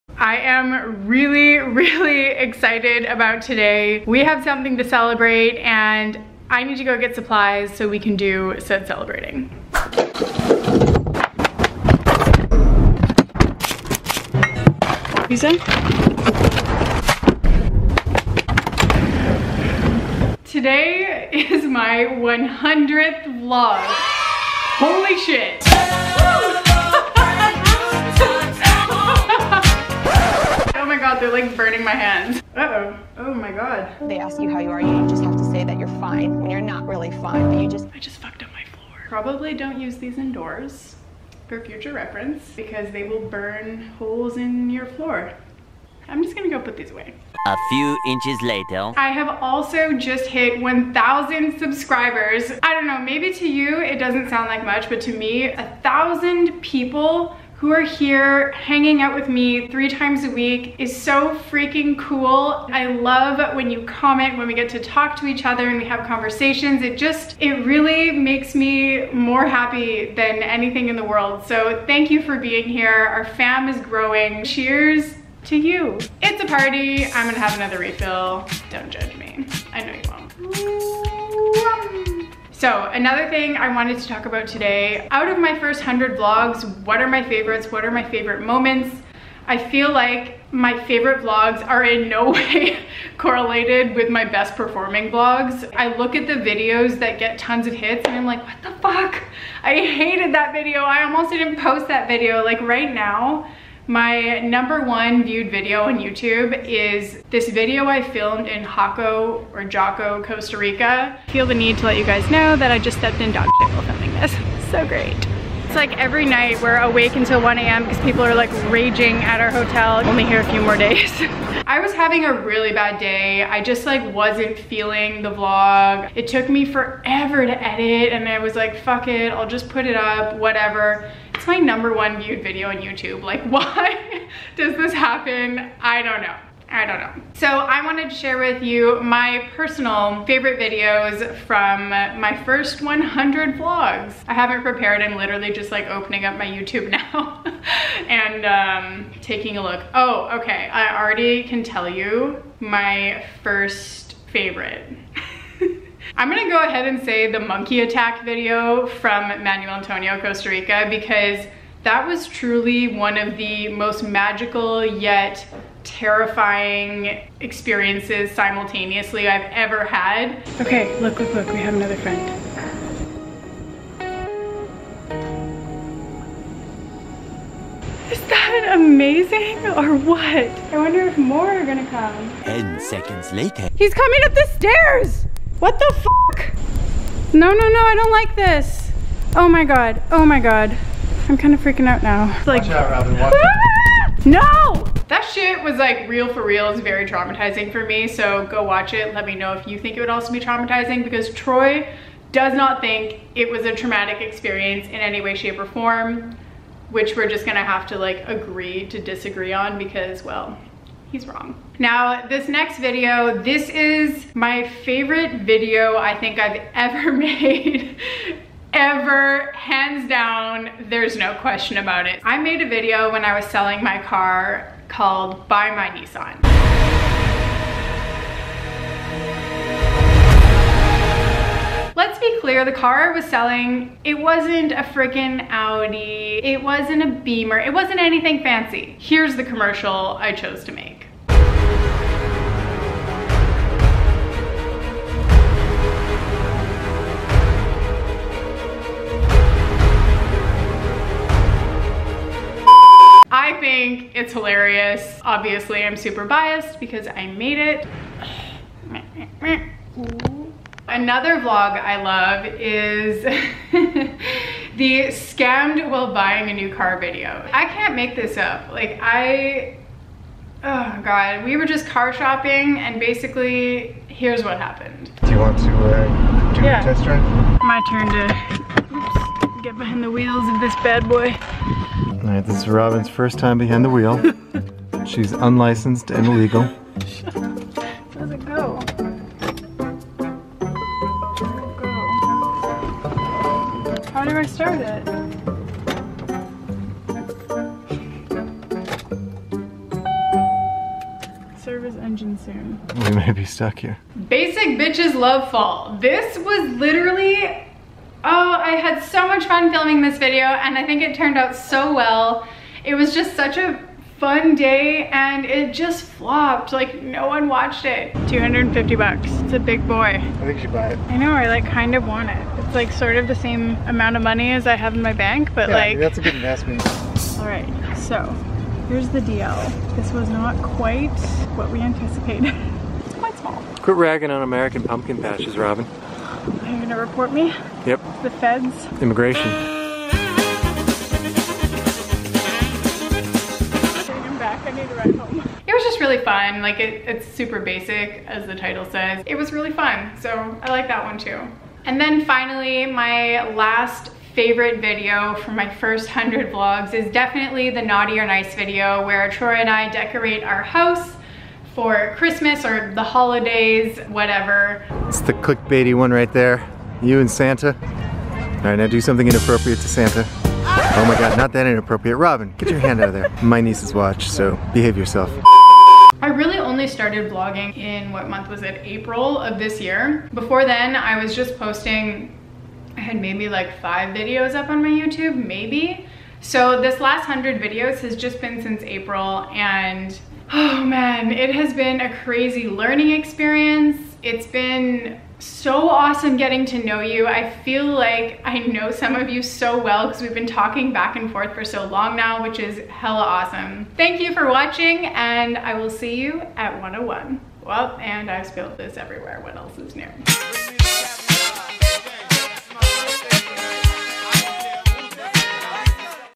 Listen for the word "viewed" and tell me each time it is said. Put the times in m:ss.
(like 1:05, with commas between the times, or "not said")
1:45, 2:12.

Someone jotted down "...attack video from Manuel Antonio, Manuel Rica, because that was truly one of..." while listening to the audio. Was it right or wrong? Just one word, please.
wrong.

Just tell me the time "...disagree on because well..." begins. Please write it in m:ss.
3:28.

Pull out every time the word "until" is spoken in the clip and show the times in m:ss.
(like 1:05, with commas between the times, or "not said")
1:57.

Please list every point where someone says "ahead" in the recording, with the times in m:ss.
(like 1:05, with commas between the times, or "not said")
2:36.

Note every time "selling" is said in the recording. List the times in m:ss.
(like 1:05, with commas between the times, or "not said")
3:43, 3:53.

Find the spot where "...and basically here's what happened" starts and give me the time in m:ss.
4:32.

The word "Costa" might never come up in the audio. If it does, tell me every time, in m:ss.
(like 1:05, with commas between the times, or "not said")
1:50, 2:40.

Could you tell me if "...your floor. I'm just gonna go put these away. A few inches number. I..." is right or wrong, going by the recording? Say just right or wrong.
wrong.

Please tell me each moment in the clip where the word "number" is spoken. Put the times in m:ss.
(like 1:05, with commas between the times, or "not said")
1:44, 2:11.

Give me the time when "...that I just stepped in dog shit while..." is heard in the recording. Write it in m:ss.
1:52.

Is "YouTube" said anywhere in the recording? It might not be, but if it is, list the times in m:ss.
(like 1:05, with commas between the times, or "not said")
1:45, 2:12, 2:26, 6:24.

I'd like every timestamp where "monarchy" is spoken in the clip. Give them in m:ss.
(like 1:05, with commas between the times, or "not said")
not said.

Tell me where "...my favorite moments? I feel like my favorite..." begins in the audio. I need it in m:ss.
1:27.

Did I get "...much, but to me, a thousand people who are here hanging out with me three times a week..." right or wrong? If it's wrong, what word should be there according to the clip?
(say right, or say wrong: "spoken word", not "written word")
right.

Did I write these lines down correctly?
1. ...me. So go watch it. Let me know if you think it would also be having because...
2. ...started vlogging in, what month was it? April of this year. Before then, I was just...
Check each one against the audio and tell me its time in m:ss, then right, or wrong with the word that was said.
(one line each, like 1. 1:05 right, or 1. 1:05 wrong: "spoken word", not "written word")
1. 3:17 wrong: "traumatizing", not "having"
2. 6:16 right.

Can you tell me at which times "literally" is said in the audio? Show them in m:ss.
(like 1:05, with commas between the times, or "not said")
2:25, 5:06.